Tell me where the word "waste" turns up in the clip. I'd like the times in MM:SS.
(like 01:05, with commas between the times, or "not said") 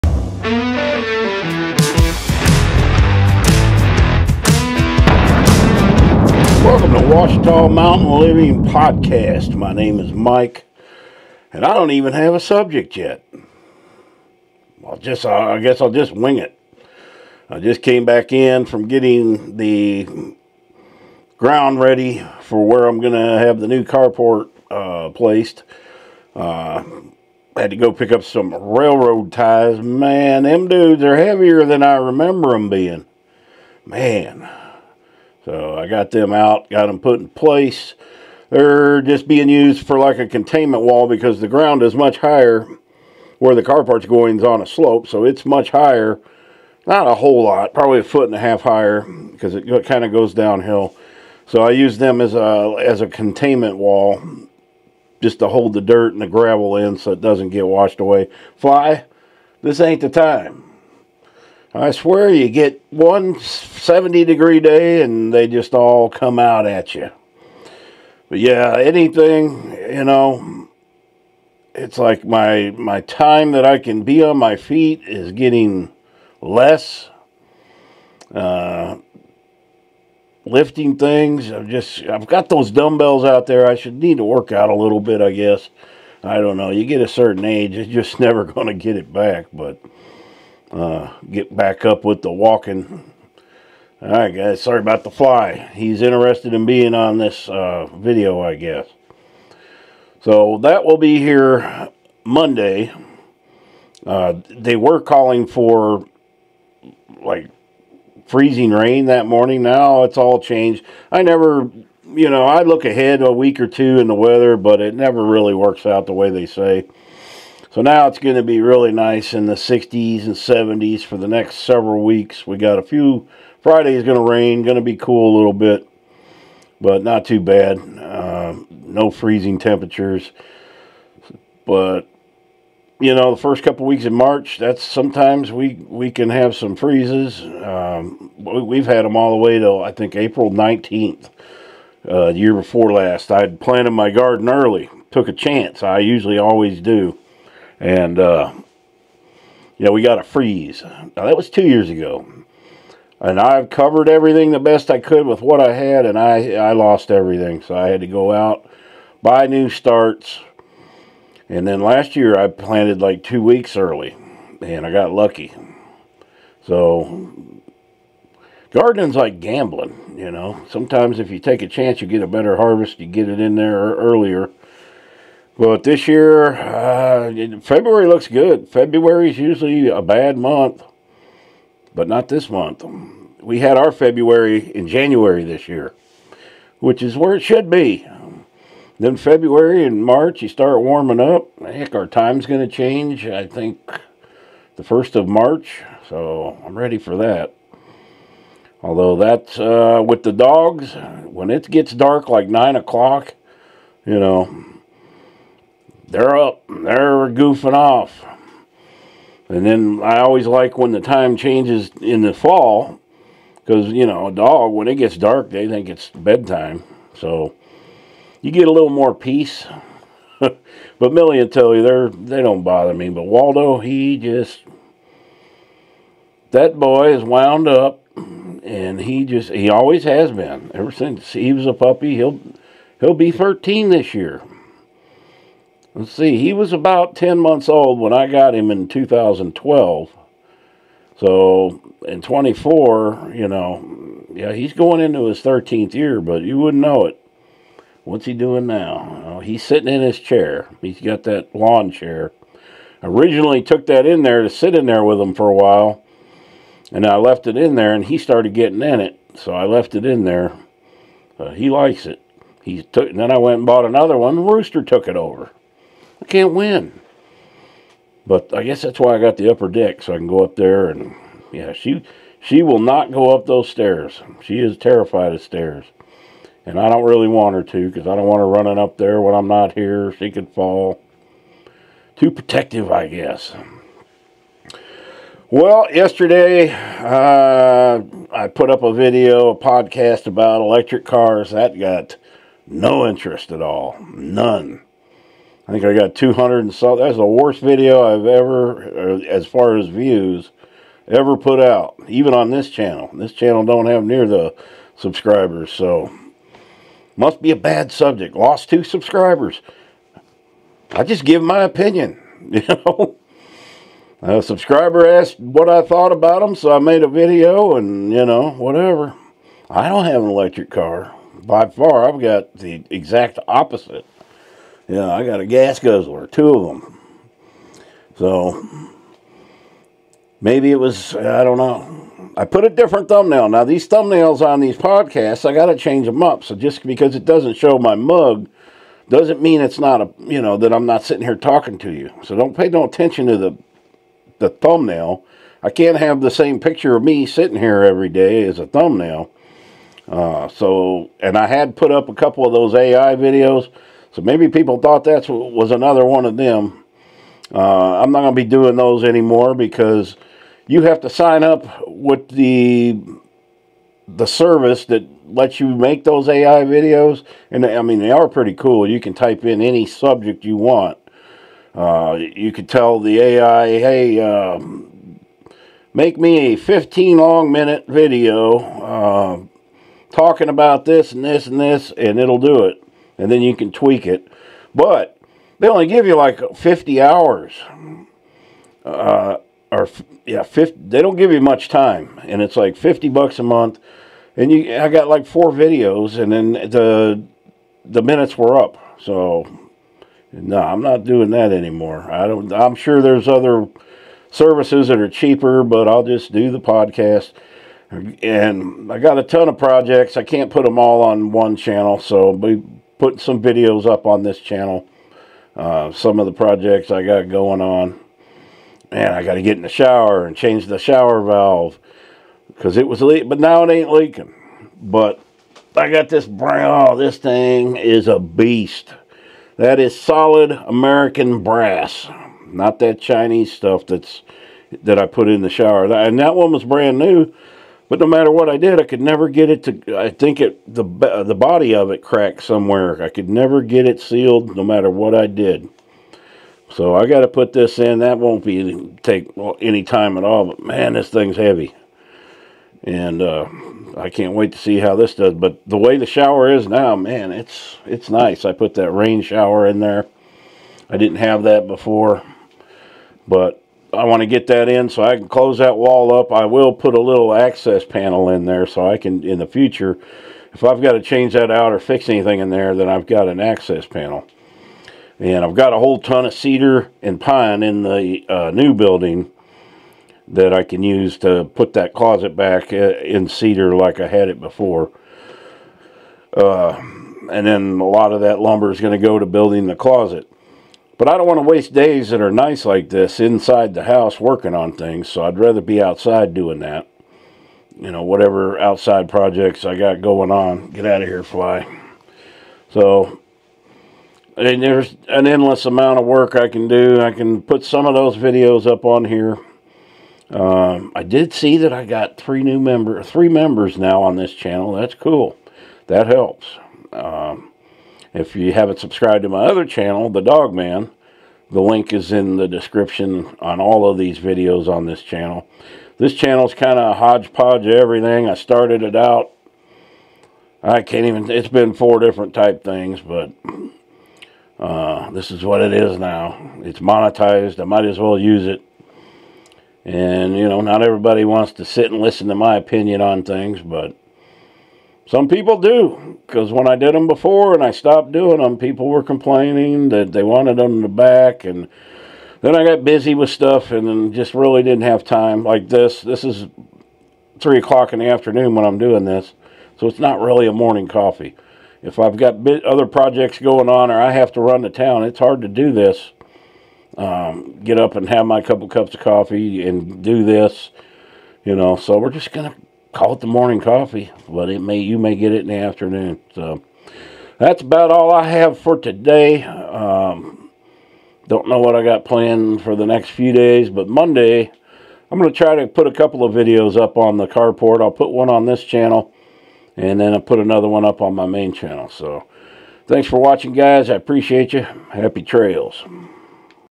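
08:11.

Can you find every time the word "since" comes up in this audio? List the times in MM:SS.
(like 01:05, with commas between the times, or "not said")
03:50.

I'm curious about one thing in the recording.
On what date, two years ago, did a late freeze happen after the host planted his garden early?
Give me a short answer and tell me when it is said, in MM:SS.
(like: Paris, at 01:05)
April 19th, at 02:20.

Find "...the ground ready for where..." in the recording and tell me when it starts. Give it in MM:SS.
00:19.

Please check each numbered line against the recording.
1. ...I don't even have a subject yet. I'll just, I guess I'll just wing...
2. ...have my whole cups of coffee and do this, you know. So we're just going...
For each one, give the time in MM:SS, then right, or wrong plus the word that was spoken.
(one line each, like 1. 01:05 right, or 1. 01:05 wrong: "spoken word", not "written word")
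1. 00:11 right
2. 09:28 wrong: "couple", not "whole".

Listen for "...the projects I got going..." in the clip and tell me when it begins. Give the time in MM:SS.
06:56.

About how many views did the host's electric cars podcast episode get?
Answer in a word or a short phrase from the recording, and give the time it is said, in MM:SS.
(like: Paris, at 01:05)
200, at 04:56.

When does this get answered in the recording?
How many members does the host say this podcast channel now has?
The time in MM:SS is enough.
08:33.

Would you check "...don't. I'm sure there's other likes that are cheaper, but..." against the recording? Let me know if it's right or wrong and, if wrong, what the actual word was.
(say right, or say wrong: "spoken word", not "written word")
wrong: "services", not "likes".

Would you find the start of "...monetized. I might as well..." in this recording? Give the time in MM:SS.
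08:56.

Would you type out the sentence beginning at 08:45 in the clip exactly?
This channel's kind of a hodgepodge of everything.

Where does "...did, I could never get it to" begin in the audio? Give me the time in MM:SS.
07:18.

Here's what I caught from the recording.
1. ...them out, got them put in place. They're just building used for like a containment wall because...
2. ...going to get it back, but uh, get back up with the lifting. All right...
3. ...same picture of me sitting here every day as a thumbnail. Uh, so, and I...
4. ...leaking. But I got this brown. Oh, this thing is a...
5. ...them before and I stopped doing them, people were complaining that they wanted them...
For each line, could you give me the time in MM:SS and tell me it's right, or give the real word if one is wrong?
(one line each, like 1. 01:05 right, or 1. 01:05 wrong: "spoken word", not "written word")
1. 00:36 wrong: "being", not "building"
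2. 01:28 wrong: "walking", not "lifting"
3. 05:46 right
4. 07:03 right
5. 09:06 right.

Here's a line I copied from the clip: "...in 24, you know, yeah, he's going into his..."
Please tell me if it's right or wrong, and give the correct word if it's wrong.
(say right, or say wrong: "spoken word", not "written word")
right.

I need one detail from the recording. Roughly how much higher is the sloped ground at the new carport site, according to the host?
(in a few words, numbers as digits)
a foot and a half.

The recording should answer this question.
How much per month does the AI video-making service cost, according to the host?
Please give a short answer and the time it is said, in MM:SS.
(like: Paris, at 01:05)
50 bucks, at 06:32.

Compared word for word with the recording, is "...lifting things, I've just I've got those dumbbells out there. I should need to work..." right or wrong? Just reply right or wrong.
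right.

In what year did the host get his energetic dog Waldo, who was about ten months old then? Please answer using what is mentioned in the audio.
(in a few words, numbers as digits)
2012.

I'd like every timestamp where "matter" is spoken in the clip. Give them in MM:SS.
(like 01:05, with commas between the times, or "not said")
07:18, 07:24.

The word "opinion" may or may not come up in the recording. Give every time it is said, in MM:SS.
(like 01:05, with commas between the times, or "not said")
05:11, 09:02.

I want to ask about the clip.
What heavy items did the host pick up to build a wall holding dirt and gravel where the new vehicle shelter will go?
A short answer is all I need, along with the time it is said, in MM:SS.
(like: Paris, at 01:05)
railroad ties, at 00:28.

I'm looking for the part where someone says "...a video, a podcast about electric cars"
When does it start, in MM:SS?
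04:48.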